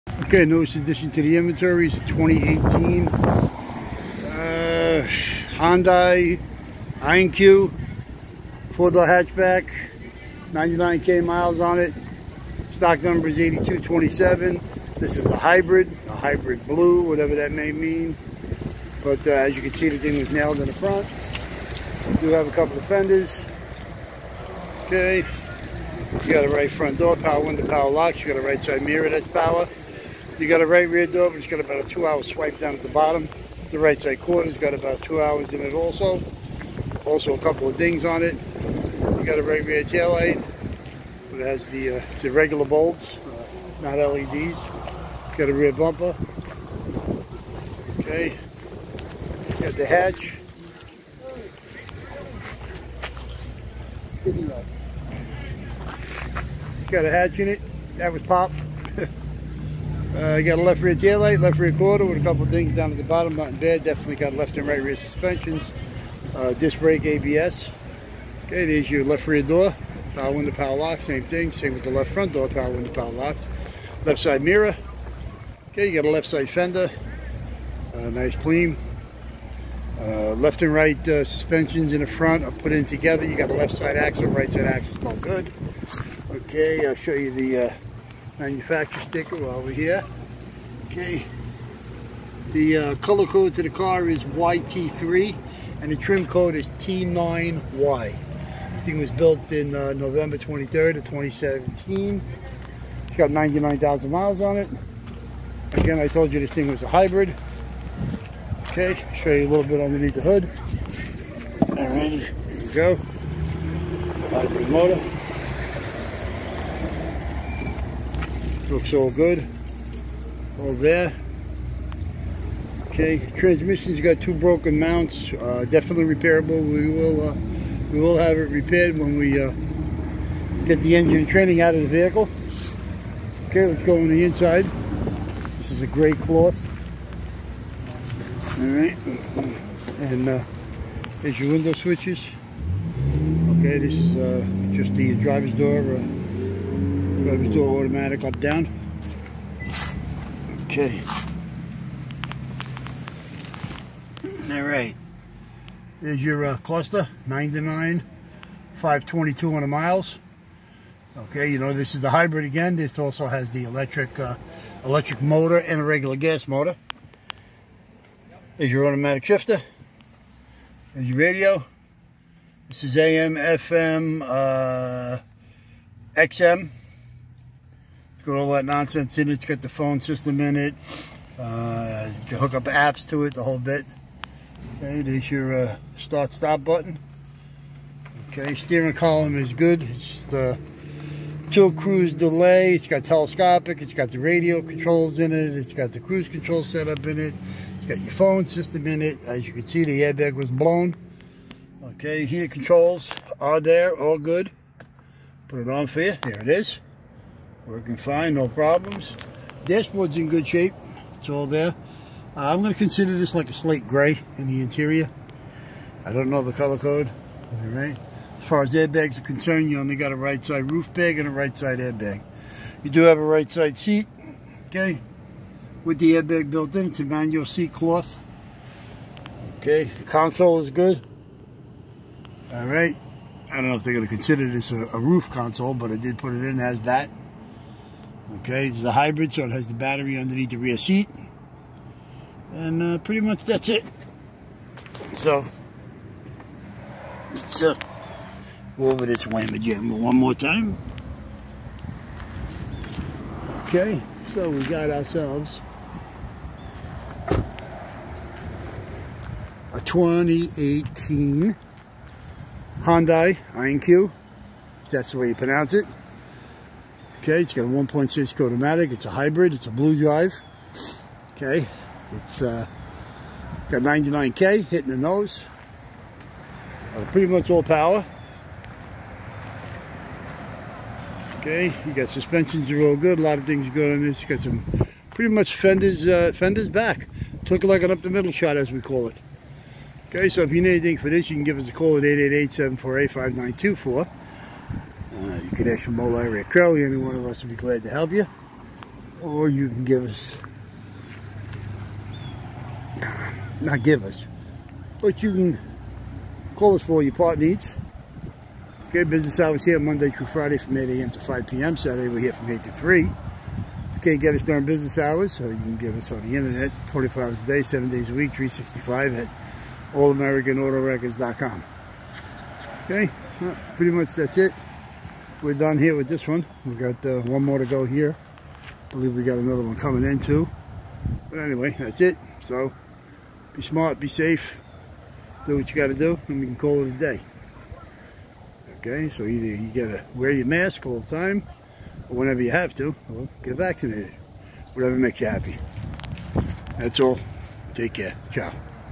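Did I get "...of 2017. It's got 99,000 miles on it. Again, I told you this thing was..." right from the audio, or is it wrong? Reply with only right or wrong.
right.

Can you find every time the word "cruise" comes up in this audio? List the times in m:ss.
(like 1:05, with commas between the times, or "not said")
3:11, 3:15.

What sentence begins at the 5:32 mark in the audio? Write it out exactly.
So be smart, be safe, do what you got to do, and we can call it a day.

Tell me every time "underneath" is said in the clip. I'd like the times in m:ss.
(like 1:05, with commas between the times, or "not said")
1:49, 4:00.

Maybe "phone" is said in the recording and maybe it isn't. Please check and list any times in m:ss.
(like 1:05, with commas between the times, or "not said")
2:59, 3:18.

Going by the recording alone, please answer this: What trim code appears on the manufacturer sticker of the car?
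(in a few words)
T9Y.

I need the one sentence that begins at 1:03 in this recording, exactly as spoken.
Definitely got left and right rear suspensions, uh, disc brake ABS.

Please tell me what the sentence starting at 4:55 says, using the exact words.
Uh, you could ask your Mole or Curly, any one of us would be glad to help you.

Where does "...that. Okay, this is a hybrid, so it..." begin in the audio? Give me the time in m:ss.
3:56.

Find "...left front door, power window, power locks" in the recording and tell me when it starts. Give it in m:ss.
1:11.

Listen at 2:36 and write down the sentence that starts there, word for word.
Is your uh, cluster, 99, 522 on the miles.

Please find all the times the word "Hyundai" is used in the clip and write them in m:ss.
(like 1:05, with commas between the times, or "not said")
0:05, 4:22.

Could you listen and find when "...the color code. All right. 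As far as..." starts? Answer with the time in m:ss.
3:36.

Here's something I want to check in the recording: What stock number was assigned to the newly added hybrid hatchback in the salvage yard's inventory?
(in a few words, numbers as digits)
8227.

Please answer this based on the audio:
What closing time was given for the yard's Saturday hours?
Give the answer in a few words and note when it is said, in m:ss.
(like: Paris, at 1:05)
3, at 5:12.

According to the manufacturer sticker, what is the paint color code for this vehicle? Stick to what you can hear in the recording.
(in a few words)
YT3.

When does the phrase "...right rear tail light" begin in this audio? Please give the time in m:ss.
0:39.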